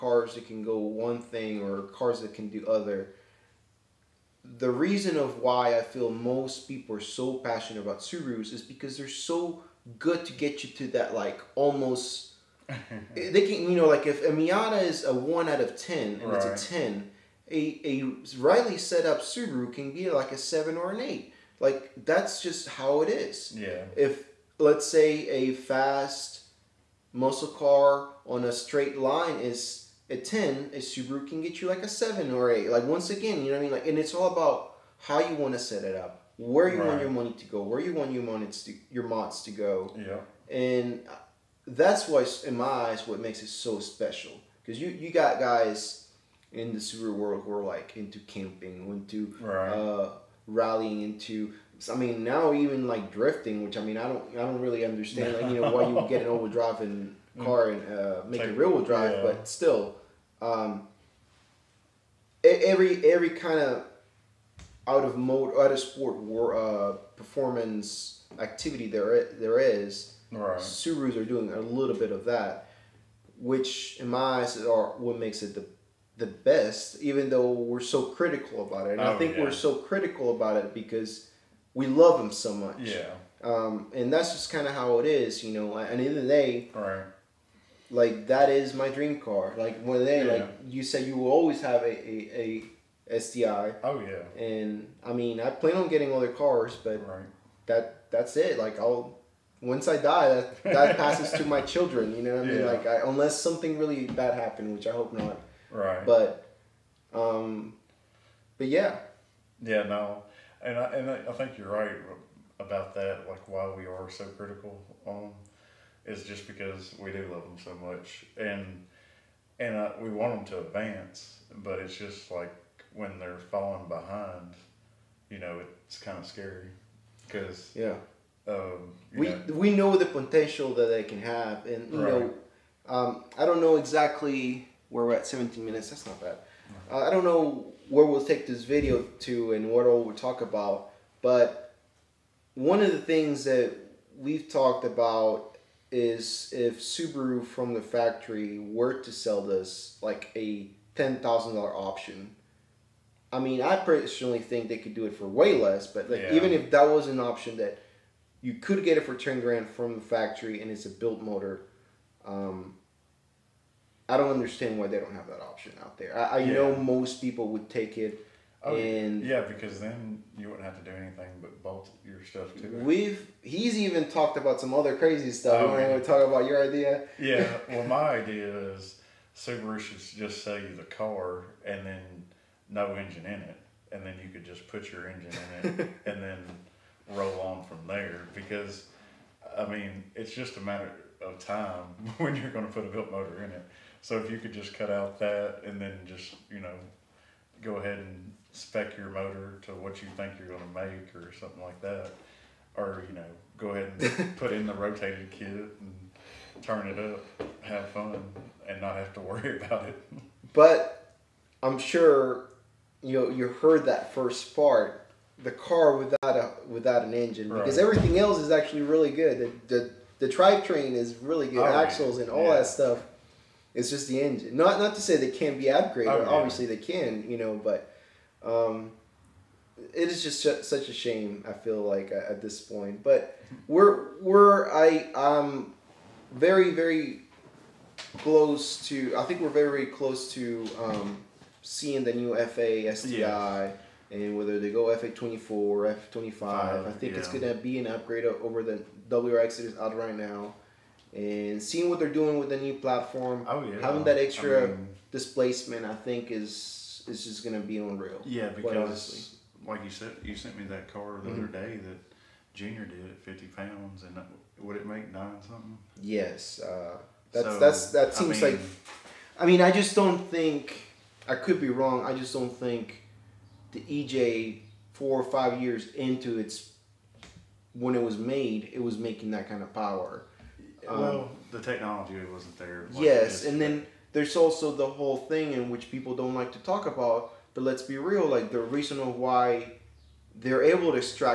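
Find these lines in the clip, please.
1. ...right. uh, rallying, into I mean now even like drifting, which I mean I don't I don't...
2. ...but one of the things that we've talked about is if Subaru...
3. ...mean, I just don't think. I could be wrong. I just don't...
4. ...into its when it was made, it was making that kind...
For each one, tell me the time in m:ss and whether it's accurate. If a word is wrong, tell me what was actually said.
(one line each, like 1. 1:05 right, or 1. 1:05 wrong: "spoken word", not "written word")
1. 0:49 right
2. 2:21 right
3. 4:29 right
4. 4:35 right.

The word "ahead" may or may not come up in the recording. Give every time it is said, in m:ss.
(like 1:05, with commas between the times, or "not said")
3:17, 3:23.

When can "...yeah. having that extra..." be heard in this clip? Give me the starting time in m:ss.
4:13.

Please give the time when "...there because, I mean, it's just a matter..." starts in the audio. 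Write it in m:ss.
3:07.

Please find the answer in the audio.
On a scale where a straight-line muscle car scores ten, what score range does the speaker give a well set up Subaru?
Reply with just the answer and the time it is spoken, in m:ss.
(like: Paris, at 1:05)
7 or 8, at 0:31.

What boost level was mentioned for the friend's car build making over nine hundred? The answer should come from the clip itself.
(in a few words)
50 pounds.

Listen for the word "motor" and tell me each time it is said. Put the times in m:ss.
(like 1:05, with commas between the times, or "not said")
2:41, 3:13, 3:19.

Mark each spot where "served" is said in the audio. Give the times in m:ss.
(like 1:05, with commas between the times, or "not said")
not said.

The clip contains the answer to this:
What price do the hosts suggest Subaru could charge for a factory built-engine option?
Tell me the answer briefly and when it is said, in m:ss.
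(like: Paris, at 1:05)
$10,000, at 2:39.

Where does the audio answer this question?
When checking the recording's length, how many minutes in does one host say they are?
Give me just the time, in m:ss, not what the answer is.
2:15.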